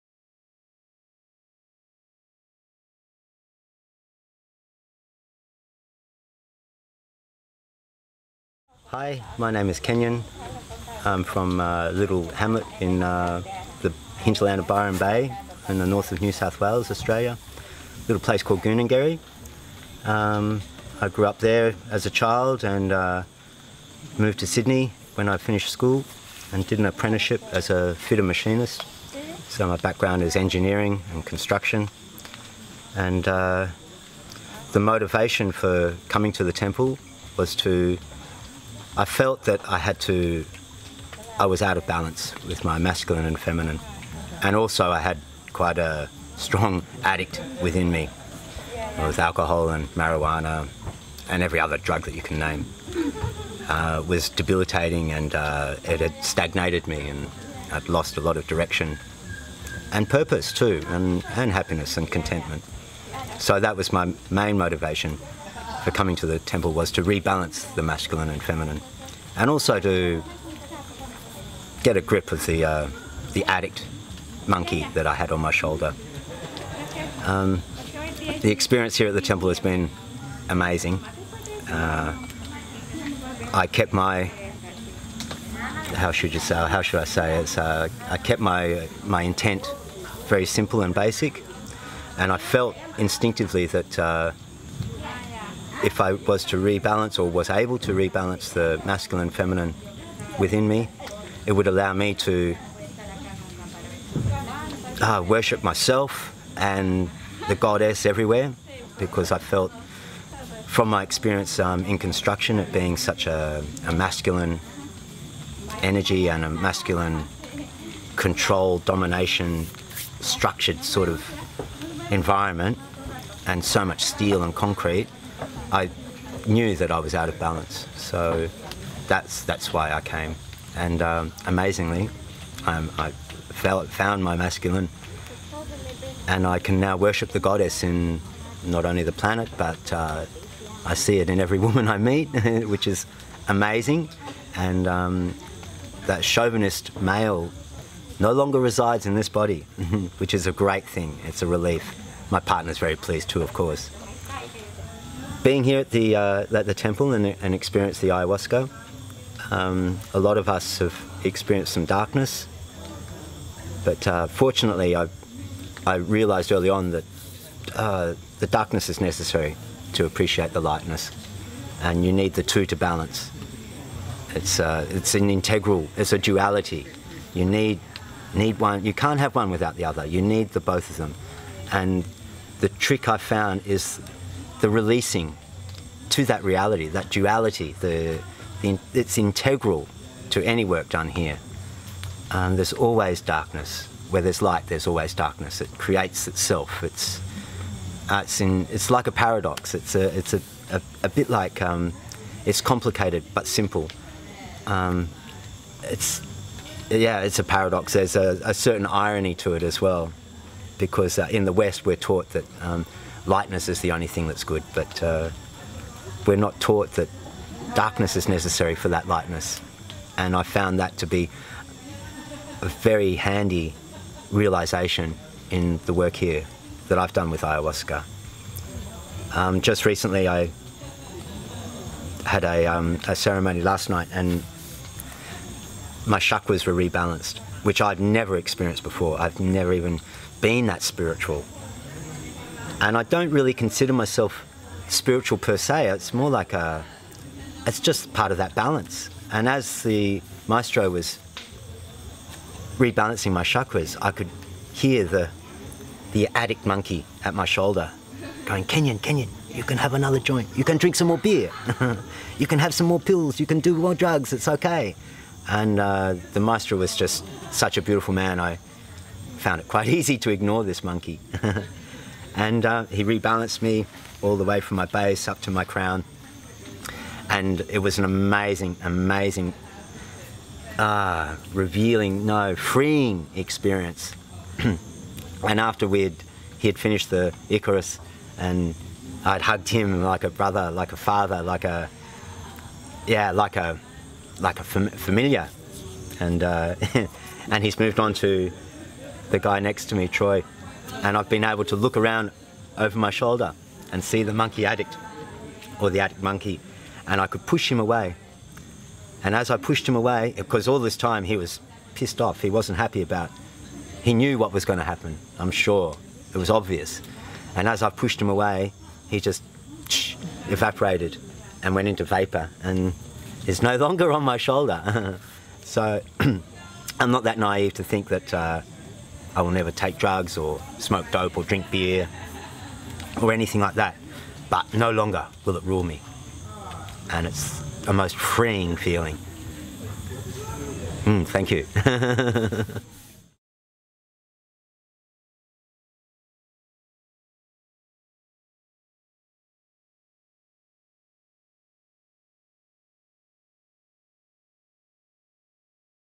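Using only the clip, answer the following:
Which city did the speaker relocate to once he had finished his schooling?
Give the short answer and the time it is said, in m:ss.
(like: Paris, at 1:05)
Sydney, at 0:24.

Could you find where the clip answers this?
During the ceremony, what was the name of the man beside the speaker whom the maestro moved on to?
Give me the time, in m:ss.
5:00.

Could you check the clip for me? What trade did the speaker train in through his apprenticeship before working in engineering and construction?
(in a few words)
Fitter machinist.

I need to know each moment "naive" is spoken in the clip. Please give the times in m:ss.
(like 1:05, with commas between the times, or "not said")
5:27.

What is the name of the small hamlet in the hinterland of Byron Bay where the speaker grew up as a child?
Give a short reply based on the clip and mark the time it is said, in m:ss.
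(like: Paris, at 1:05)
Goonengerry, at 0:18.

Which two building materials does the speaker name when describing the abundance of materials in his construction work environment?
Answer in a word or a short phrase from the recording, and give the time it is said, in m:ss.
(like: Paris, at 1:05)
Steel and concrete, at 2:04.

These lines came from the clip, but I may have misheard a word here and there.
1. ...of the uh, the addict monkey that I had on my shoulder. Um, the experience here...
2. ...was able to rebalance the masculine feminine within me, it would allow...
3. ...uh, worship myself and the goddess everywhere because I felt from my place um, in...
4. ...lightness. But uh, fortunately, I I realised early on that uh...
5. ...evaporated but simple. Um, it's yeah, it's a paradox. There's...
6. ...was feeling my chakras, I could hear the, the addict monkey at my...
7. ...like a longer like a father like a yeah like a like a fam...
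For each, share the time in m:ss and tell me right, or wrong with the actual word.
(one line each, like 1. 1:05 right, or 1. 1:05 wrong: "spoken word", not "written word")
1. 1:12 right
2. 1:37 right
3. 1:45 wrong: "experience", not "place"
4. 2:41 wrong: "darkness", not "lightness"
5. 3:22 wrong: "complicated", not "evaporated"
6. 4:10 wrong: "rebalancing", not "feeling"
7. 4:50 wrong: "brother", not "longer".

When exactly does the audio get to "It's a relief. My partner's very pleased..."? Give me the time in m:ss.
2:31.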